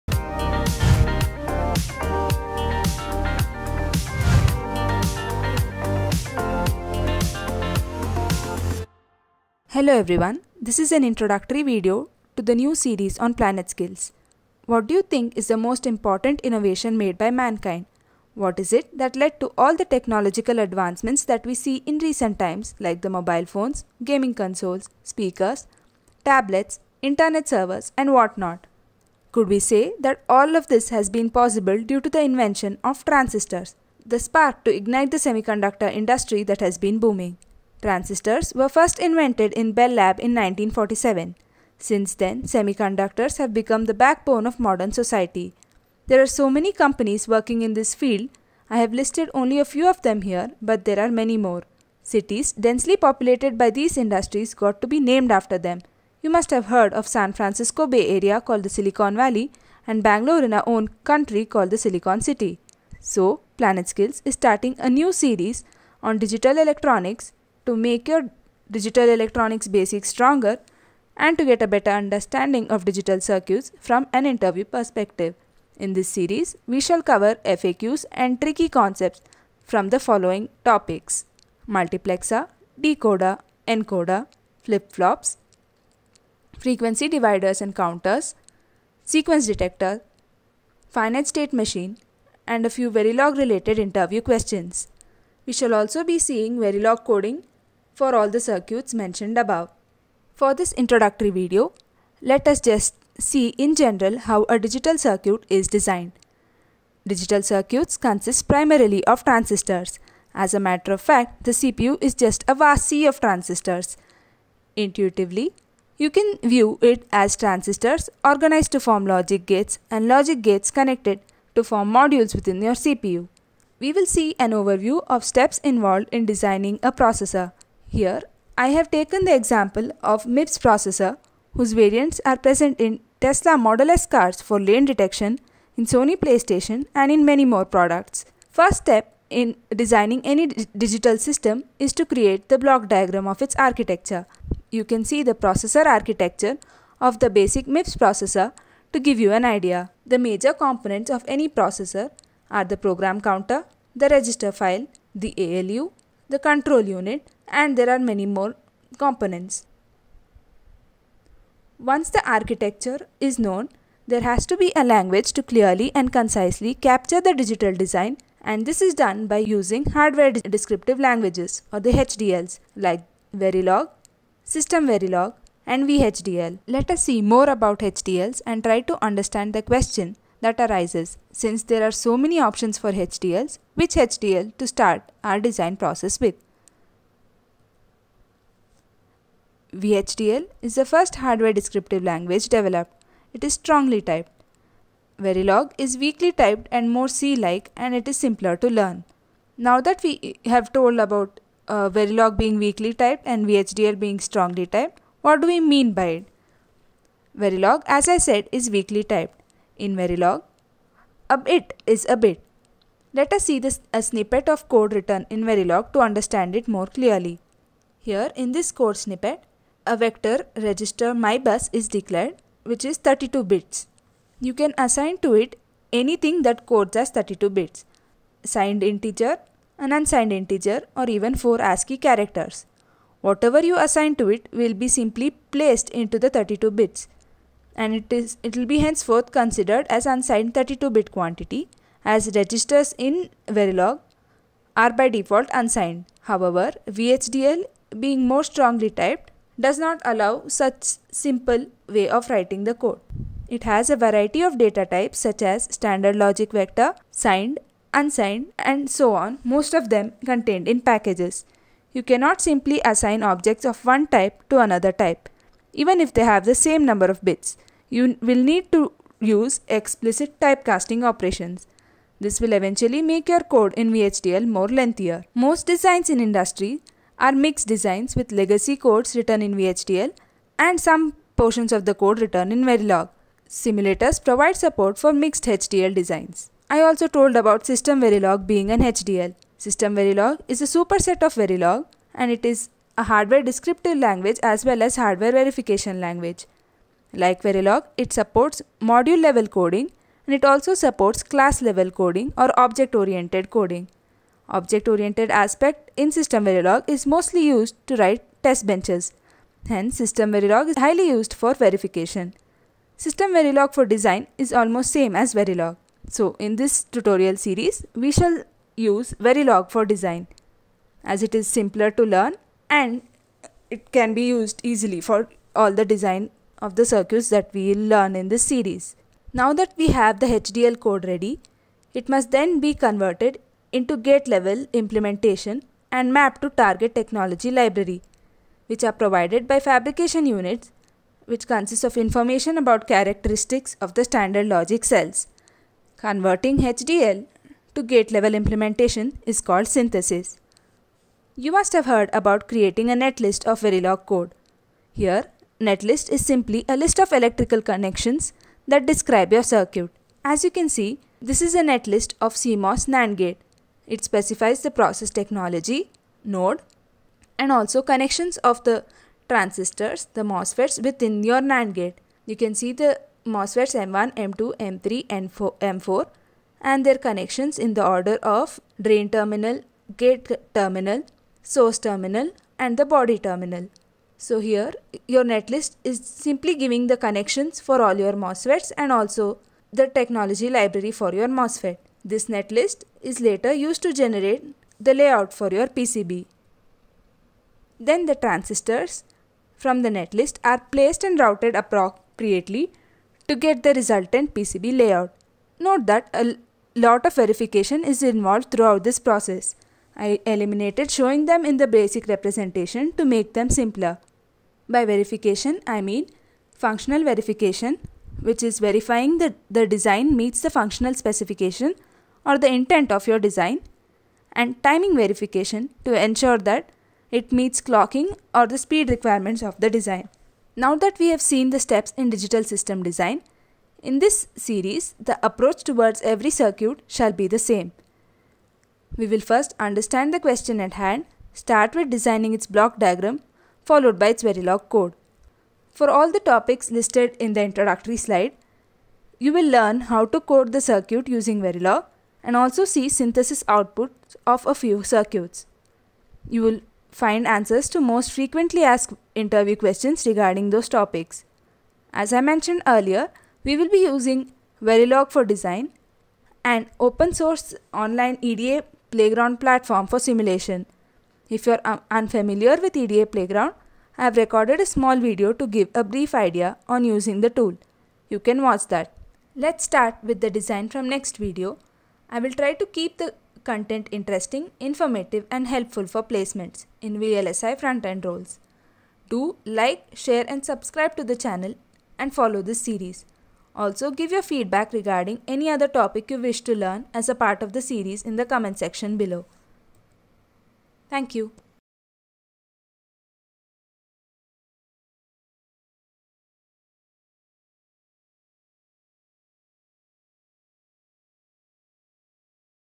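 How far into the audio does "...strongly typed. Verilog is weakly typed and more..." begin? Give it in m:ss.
3:13.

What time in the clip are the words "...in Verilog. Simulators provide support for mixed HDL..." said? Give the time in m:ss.
4:42.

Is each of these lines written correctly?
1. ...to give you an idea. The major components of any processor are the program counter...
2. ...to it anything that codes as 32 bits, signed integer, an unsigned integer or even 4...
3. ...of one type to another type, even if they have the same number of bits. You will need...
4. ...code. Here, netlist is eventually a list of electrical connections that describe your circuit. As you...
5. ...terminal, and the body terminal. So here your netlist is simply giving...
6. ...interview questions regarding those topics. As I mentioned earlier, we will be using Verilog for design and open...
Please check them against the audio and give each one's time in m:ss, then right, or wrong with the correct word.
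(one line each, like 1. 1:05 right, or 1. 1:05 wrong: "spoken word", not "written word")
1. 2:28 right
2. 3:45 right
3. 4:23 right
4. 5:54 wrong: "simply", not "eventually"
5. 6:21 right
6. 7:39 right.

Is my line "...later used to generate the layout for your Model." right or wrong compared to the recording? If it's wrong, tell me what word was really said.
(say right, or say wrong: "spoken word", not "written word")
wrong: "PCB", not "Model".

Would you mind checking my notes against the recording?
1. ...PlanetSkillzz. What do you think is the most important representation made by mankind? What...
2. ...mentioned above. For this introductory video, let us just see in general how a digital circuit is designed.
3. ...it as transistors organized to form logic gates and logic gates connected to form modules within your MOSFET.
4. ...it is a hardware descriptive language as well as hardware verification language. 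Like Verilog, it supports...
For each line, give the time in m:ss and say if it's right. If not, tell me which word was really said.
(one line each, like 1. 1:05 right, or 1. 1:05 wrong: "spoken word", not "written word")
1. 0:13 wrong: "innovation", not "representation"
2. 1:38 right
3. 1:56 wrong: "CPU", not "MOSFET"
4. 4:52 right.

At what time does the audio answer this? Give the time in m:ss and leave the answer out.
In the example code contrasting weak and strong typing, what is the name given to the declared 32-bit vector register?
3:41.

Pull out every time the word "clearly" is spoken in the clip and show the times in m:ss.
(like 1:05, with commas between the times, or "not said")
2:45, 3:36.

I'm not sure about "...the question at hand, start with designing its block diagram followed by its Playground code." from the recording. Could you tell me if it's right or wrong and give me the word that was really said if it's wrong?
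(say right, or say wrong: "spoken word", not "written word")
wrong: "Verilog", not "Playground".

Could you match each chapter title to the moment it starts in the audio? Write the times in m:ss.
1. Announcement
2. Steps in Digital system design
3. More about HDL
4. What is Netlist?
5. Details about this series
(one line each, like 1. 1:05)
1. 0:10
2. 1:45
3. 3:08
4. 5:34
5. 7:15.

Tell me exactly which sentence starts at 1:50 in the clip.
As a matter of fact, the CPU is just a vast sea of transistors.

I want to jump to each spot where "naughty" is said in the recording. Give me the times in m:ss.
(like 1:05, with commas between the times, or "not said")
not said.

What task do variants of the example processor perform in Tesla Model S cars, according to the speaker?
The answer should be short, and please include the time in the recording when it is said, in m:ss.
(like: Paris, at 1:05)
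Lane detection, at 2:14.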